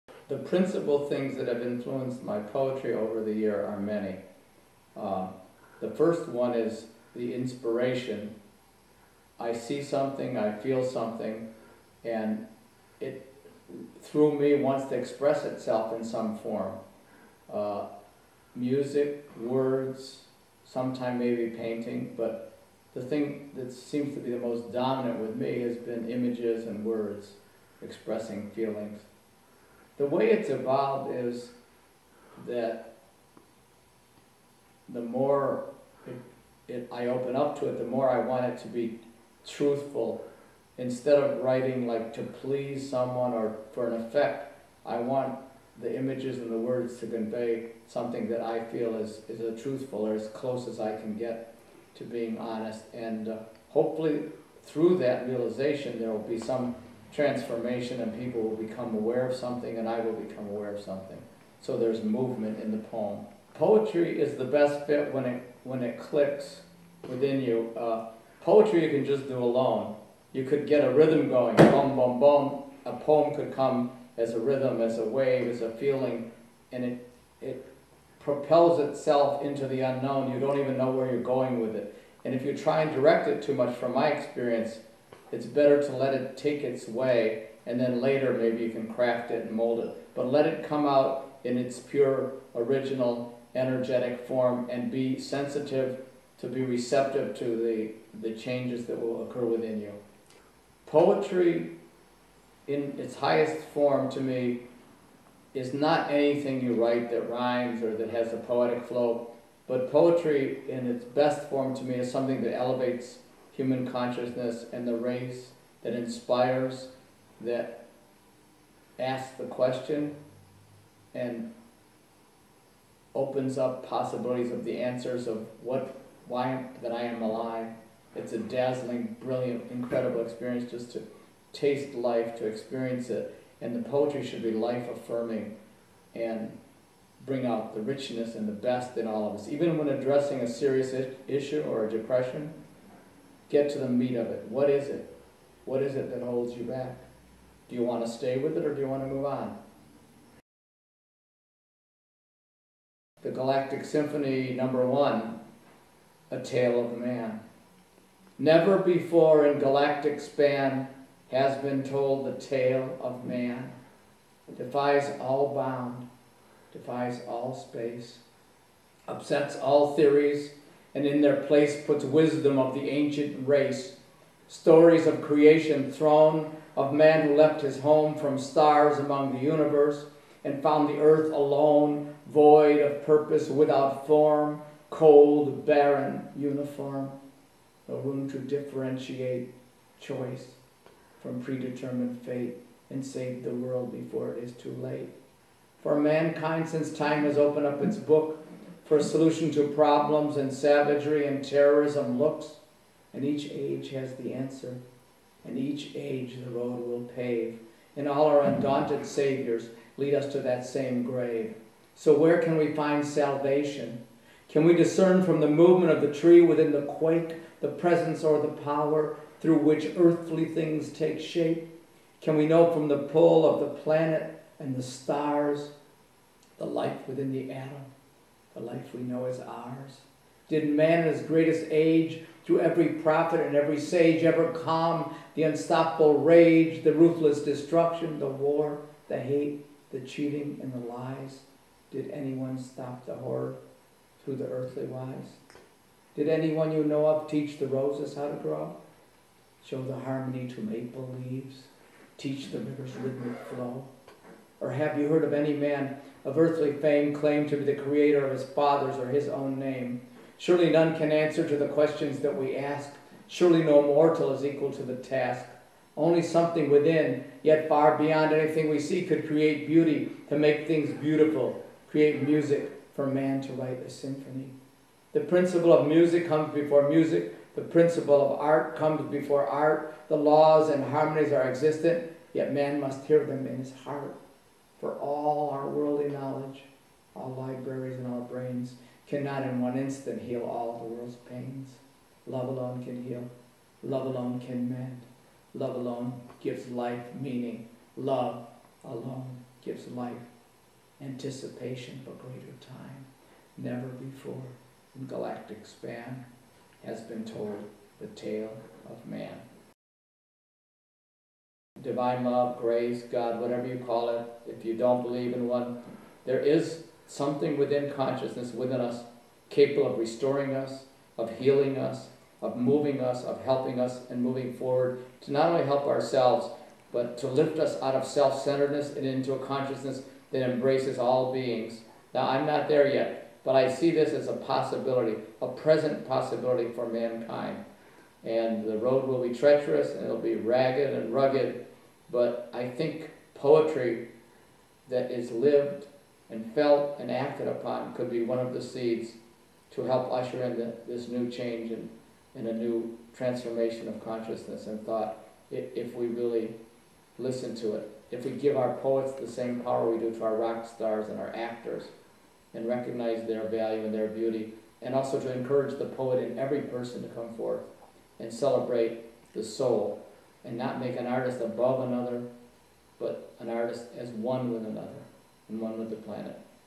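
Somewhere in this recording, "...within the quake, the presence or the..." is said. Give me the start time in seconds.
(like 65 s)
216 s.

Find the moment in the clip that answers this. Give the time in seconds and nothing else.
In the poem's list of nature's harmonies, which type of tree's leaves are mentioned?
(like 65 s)
250 s.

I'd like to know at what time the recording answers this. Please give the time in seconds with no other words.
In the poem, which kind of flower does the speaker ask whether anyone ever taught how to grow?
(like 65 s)
247 s.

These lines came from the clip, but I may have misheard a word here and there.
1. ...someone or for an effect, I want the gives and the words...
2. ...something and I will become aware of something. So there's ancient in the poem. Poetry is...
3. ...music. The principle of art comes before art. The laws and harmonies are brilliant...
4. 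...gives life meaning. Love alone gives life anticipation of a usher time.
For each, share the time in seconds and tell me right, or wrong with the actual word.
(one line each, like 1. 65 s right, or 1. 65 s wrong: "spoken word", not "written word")
1. 42 s wrong: "images", not "gives"
2. 59 s wrong: "movement", not "ancient"
3. 276 s wrong: "existent", not "brilliant"
4. 296 s wrong: "greater", not "usher".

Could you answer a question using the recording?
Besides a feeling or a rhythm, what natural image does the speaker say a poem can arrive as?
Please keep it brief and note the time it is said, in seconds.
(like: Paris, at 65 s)
A wave, at 74 s.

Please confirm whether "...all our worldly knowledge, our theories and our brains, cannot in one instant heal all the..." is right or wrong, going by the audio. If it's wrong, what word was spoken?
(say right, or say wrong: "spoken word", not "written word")
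wrong: "libraries", not "theories".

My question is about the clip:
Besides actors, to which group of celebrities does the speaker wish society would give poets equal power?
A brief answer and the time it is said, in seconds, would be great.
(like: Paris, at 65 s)
Rock stars, at 360 s.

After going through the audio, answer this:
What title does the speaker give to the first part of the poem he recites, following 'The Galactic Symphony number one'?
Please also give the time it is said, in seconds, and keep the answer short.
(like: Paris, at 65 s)
A Tale of Man, at 156 s.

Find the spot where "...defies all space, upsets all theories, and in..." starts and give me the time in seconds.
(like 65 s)
166 s.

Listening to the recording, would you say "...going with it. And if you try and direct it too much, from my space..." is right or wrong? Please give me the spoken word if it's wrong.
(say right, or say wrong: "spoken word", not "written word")
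wrong: "experience", not "space".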